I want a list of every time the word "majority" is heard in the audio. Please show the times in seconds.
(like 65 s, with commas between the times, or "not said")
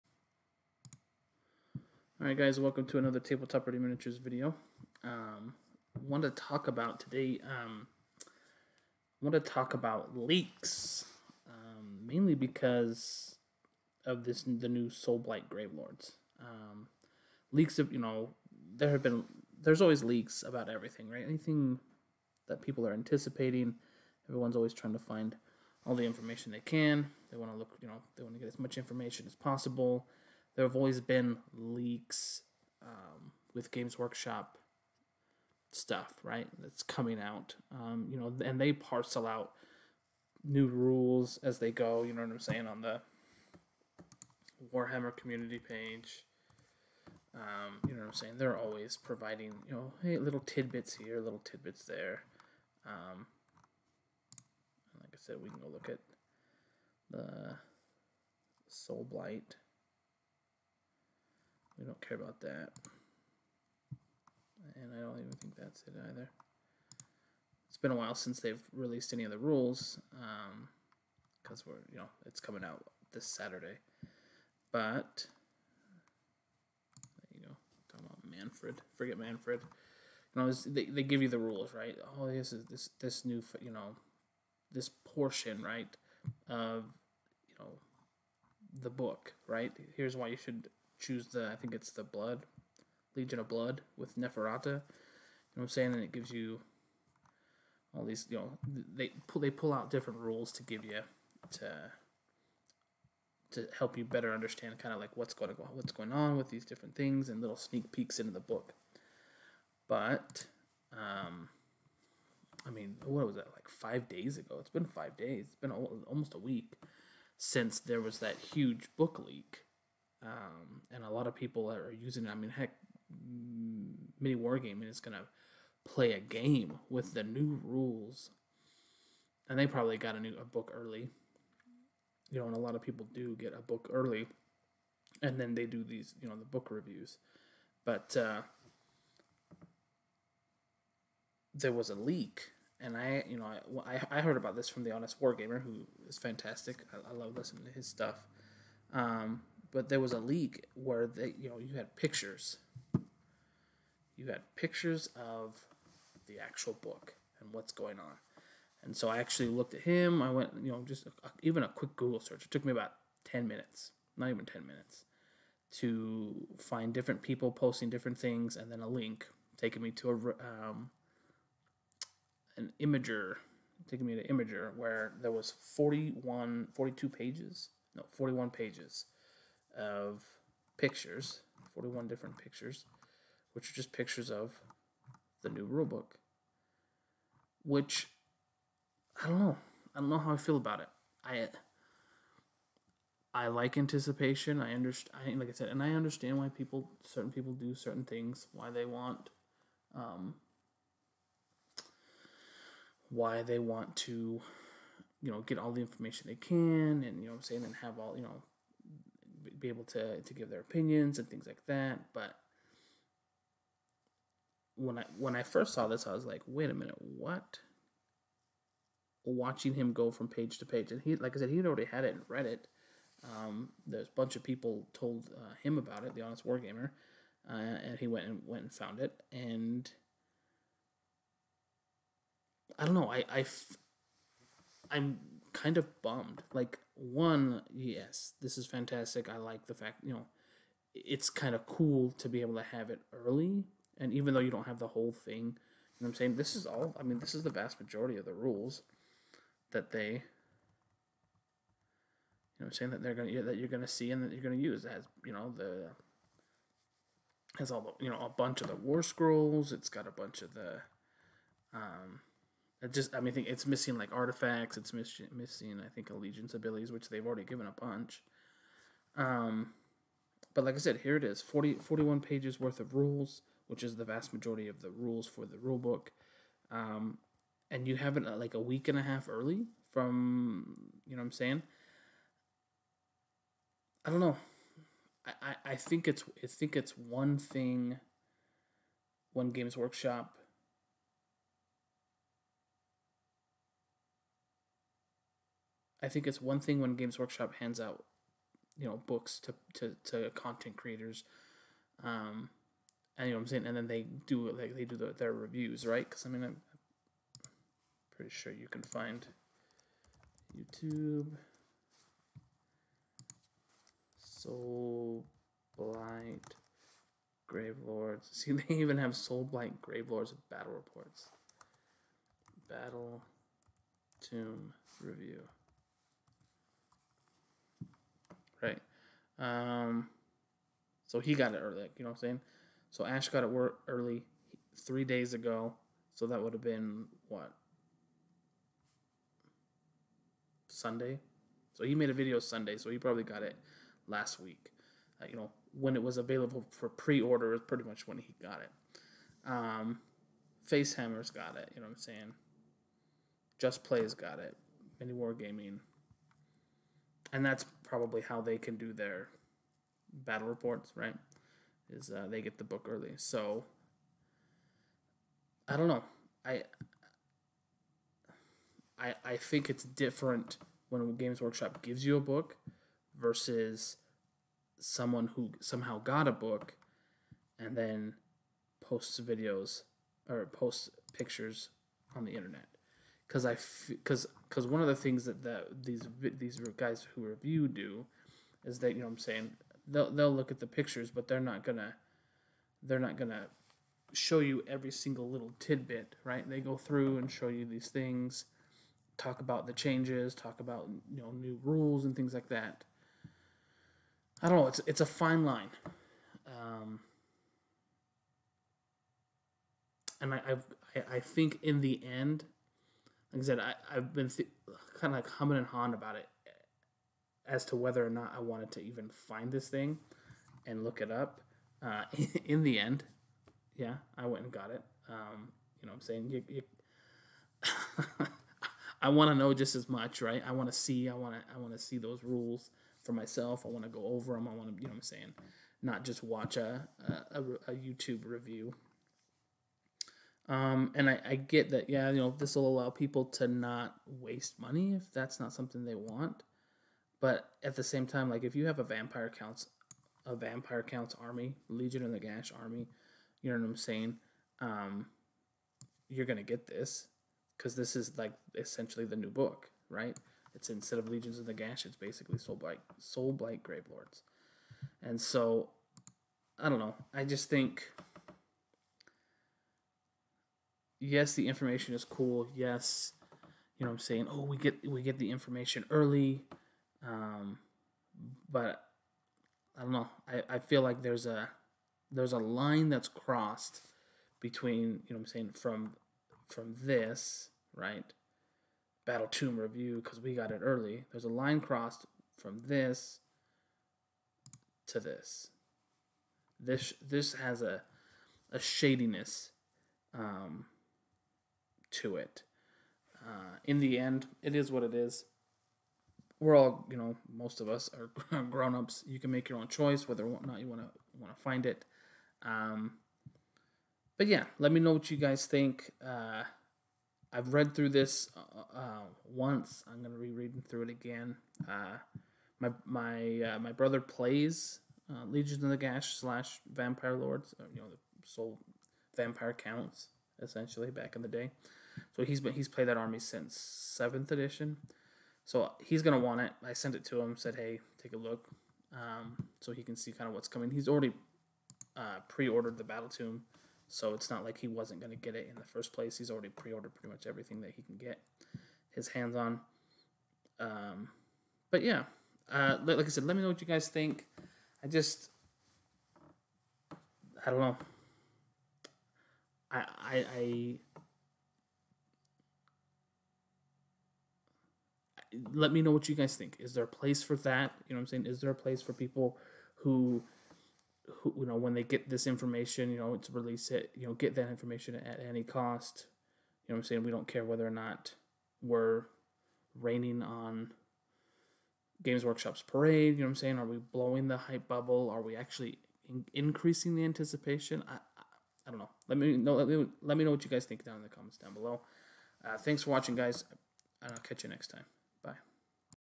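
247 s, 274 s.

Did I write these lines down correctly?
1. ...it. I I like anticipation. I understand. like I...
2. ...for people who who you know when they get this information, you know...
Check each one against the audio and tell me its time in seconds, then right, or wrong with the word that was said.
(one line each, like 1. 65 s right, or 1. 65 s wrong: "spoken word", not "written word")
1. 190 s right
2. 568 s right.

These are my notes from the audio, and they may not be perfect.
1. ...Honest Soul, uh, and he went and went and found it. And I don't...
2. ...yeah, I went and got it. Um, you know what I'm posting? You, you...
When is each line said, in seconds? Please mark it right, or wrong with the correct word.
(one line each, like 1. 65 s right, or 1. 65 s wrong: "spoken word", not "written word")
1. 226 s wrong: "Wargamer", not "Soul"
2. 423 s wrong: "saying", not "posting".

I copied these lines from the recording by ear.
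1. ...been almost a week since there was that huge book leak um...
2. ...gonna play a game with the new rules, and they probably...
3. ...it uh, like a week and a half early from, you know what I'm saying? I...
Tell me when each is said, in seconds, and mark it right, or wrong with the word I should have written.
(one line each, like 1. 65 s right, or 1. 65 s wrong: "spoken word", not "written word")
1. 115 s right
2. 124 s right
3. 278 s right.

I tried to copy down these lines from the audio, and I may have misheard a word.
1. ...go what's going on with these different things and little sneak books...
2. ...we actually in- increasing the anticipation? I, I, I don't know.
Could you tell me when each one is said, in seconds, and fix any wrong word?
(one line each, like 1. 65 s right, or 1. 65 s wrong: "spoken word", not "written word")
1. 105 s wrong: "peeks", not "books"
2. 585 s right.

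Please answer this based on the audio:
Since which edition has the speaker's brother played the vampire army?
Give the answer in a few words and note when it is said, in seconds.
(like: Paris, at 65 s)
Seventh edition, at 533 s.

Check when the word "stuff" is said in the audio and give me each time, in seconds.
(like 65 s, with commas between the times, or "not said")
35 s, 147 s.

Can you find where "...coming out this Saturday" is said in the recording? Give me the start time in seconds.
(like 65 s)
72 s.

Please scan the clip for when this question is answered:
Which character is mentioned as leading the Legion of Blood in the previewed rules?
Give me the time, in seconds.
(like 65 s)
94 s.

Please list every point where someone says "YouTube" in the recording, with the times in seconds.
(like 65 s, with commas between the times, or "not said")
310 s, 437 s.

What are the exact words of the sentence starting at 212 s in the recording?
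But when I when I first saw this, I was like, wait a minute, what?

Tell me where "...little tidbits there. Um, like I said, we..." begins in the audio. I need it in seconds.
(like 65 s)
51 s.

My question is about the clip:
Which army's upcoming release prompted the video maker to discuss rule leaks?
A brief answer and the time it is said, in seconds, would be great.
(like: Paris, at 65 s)
Soulblight Gravelords, at 14 s.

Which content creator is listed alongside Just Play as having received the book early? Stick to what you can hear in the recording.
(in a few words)
Facehammer.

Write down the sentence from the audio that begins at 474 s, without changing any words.
Oh, we get we get the information early, um, but I don't know.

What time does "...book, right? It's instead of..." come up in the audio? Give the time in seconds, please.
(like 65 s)
459 s.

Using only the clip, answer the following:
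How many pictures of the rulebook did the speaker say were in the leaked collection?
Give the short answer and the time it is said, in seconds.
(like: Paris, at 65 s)
41, at 181 s.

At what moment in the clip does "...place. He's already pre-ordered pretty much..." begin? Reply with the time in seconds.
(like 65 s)
545 s.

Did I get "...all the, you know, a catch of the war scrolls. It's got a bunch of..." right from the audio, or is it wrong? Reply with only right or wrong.
wrong.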